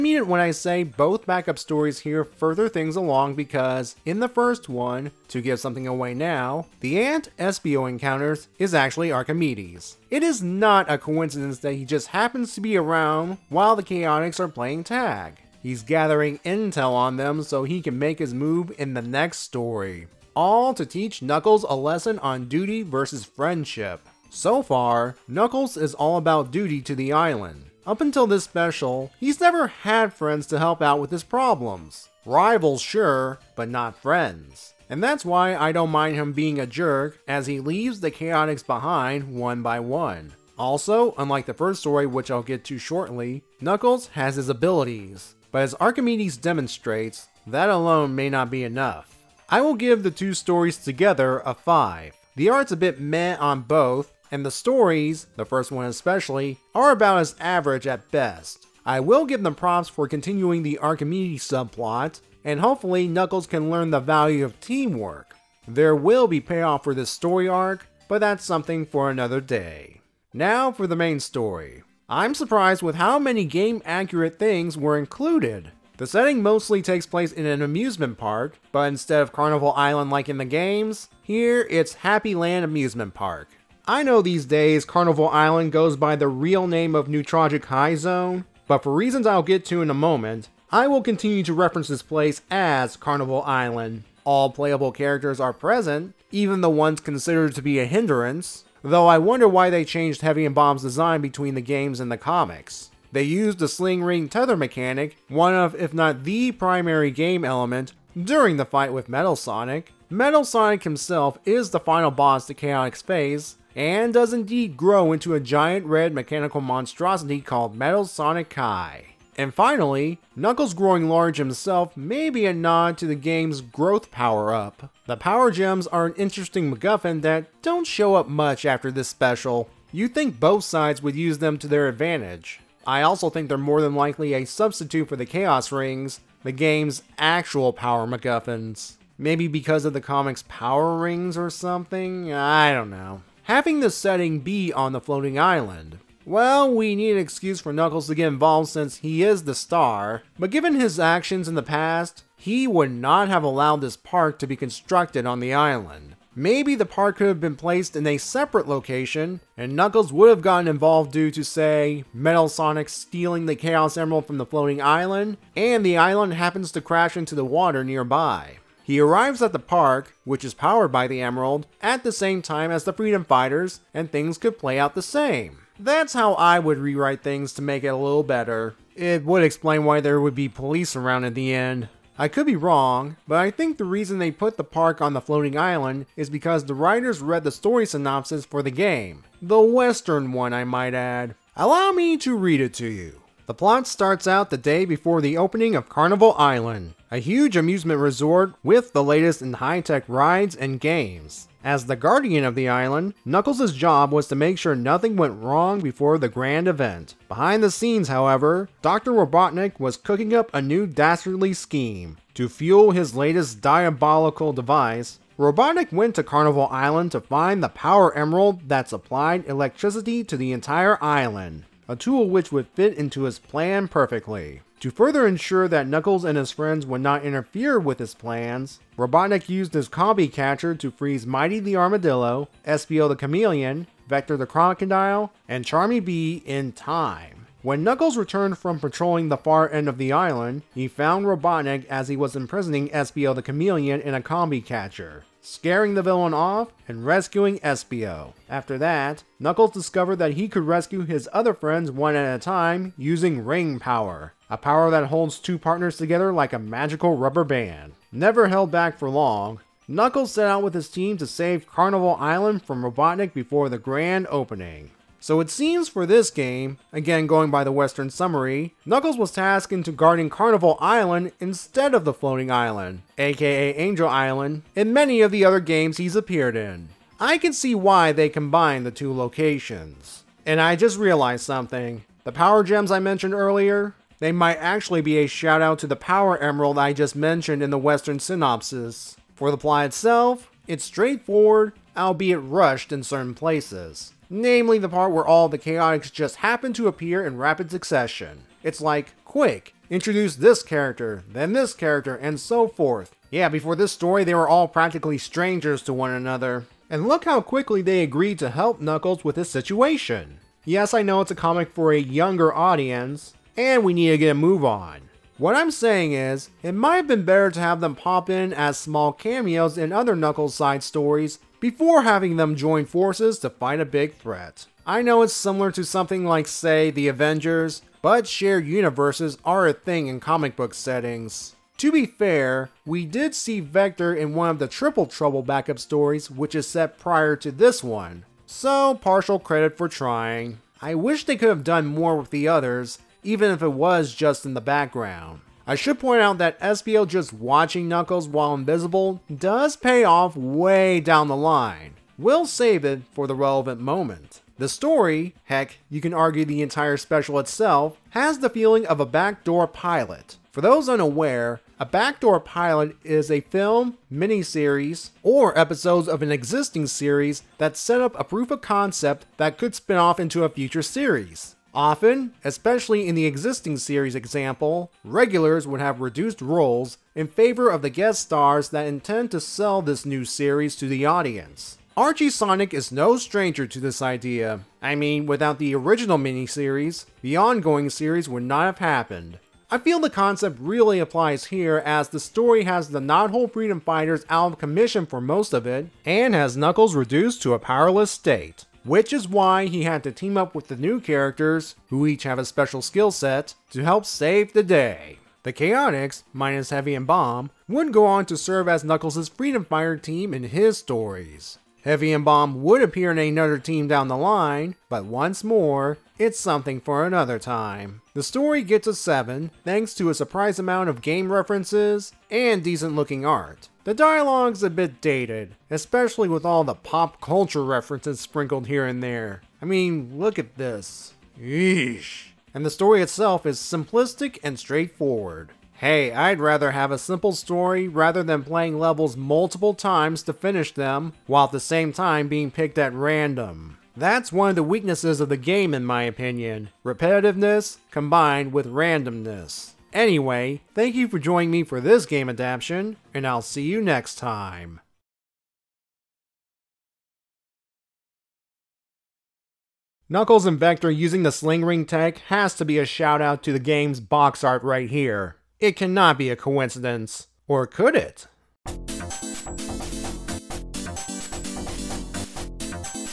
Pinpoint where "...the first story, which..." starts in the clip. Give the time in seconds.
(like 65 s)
41 s.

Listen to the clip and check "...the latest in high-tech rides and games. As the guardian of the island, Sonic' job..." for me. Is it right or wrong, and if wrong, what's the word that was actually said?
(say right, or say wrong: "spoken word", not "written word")
wrong: "Knuckles", not "Sonic".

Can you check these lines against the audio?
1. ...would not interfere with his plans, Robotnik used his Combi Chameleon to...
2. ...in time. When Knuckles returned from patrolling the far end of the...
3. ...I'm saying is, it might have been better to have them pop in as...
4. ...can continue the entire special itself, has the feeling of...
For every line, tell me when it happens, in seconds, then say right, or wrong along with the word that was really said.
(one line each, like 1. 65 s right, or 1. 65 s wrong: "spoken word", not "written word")
1. 226 s wrong: "Catcher", not "Chameleon"
2. 236 s right
3. 315 s right
4. 355 s wrong: "argue", not "continue".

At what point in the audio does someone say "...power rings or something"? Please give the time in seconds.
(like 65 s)
140 s.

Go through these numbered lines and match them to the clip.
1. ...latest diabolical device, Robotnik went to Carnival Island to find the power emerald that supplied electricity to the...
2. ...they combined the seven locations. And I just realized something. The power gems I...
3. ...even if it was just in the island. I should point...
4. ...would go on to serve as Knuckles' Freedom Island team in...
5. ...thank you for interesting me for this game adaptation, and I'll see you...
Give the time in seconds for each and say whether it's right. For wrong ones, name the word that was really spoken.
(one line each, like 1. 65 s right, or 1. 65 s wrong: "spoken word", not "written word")
1. 213 s right
2. 278 s wrong: "two", not "seven"
3. 343 s wrong: "background", not "island"
4. 407 s wrong: "Fighter", not "Island"
5. 450 s wrong: "joining", not "interesting".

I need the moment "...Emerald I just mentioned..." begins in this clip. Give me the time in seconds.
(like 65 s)
286 s.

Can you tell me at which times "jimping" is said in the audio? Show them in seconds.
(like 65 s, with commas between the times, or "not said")
not said.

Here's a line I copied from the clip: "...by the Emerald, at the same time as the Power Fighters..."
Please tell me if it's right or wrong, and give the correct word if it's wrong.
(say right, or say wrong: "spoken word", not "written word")
wrong: "Freedom", not "Power".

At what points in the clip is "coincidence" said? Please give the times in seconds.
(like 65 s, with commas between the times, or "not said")
10 s, 466 s.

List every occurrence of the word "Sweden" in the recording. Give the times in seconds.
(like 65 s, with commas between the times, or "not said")
not said.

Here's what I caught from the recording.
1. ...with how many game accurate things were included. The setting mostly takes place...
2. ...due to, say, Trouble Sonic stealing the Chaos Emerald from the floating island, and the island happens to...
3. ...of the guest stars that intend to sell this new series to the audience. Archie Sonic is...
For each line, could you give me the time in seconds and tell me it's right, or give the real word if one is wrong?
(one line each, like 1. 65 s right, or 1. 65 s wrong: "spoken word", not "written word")
1. 72 s right
2. 161 s wrong: "Metal", not "Trouble"
3. 377 s right.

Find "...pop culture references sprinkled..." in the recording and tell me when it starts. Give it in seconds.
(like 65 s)
426 s.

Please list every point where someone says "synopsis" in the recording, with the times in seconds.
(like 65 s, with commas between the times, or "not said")
187 s, 288 s.